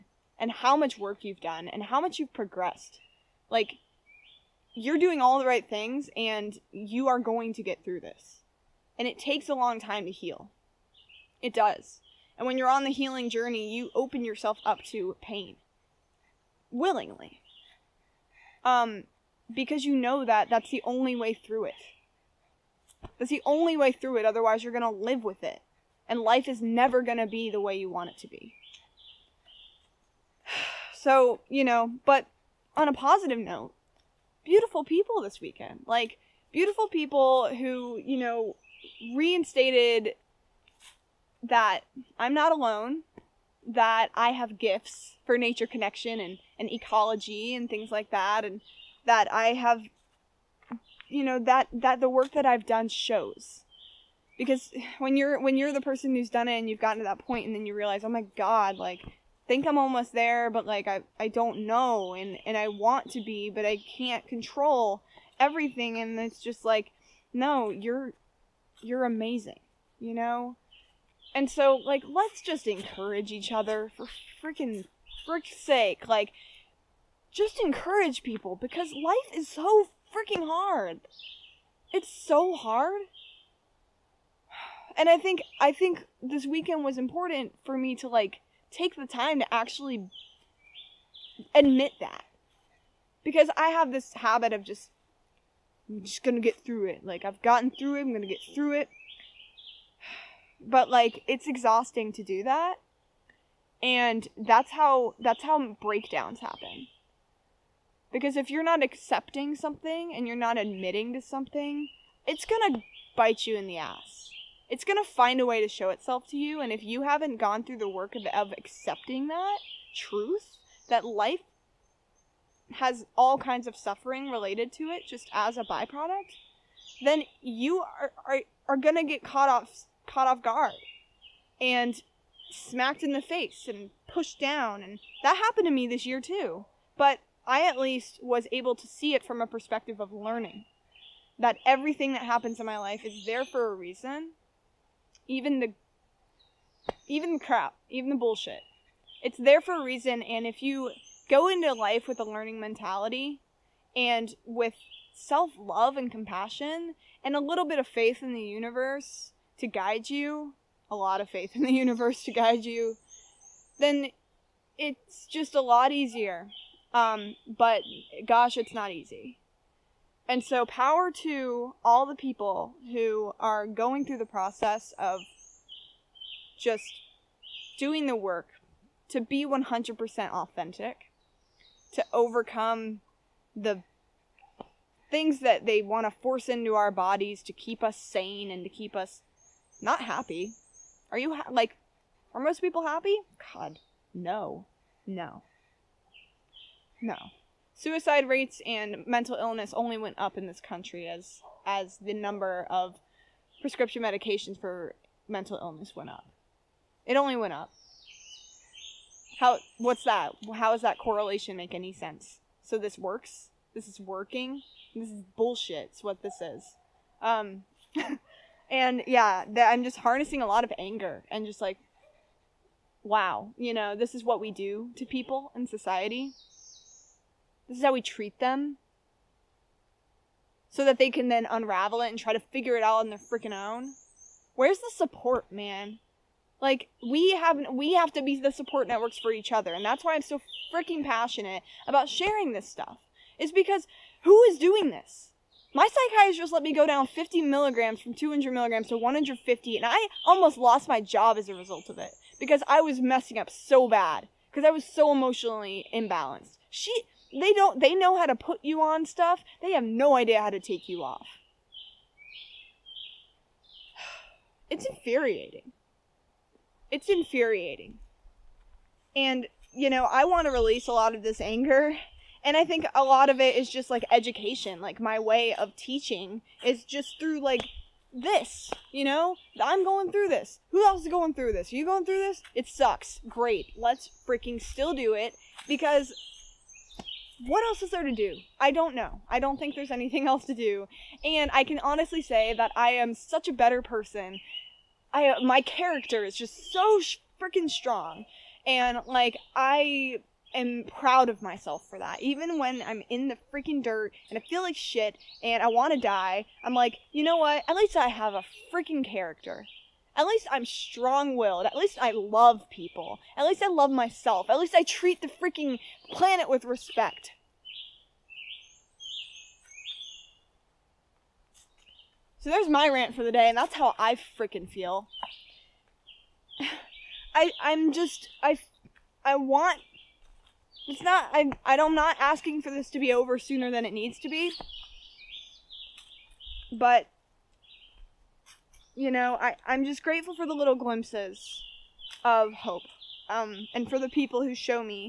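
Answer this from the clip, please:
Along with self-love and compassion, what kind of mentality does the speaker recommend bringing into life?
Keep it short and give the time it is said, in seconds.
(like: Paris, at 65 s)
learning mentality, at 152 s.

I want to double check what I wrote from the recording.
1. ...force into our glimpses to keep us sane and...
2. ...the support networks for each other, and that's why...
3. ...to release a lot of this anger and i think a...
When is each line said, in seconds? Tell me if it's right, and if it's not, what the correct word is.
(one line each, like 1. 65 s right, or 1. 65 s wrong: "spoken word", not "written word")
1. 186 s wrong: "bodies", not "glimpses"
2. 238 s right
3. 270 s right.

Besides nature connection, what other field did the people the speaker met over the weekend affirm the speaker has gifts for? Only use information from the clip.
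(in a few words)
ecology.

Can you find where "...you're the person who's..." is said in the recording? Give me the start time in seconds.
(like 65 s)
55 s.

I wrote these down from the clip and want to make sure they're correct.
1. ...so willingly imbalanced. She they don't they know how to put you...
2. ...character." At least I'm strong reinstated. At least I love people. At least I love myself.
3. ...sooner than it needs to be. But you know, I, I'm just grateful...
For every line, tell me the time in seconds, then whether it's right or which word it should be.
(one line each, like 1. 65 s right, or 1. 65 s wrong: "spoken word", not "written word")
1. 254 s wrong: "emotionally", not "willingly"
2. 309 s wrong: "willed", not "reinstated"
3. 333 s right.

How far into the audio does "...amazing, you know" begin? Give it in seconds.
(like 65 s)
69 s.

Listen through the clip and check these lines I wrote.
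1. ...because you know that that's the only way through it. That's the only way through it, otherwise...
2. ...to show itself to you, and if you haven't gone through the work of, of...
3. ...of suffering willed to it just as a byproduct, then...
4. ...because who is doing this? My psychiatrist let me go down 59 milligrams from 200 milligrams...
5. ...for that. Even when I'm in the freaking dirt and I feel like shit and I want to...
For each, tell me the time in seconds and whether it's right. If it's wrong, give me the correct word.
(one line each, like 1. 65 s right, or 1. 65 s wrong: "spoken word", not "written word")
1. 19 s right
2. 115 s right
3. 123 s wrong: "related", not "willed"
4. 243 s wrong: "50", not "59"
5. 301 s right.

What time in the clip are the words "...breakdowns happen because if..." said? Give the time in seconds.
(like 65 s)
105 s.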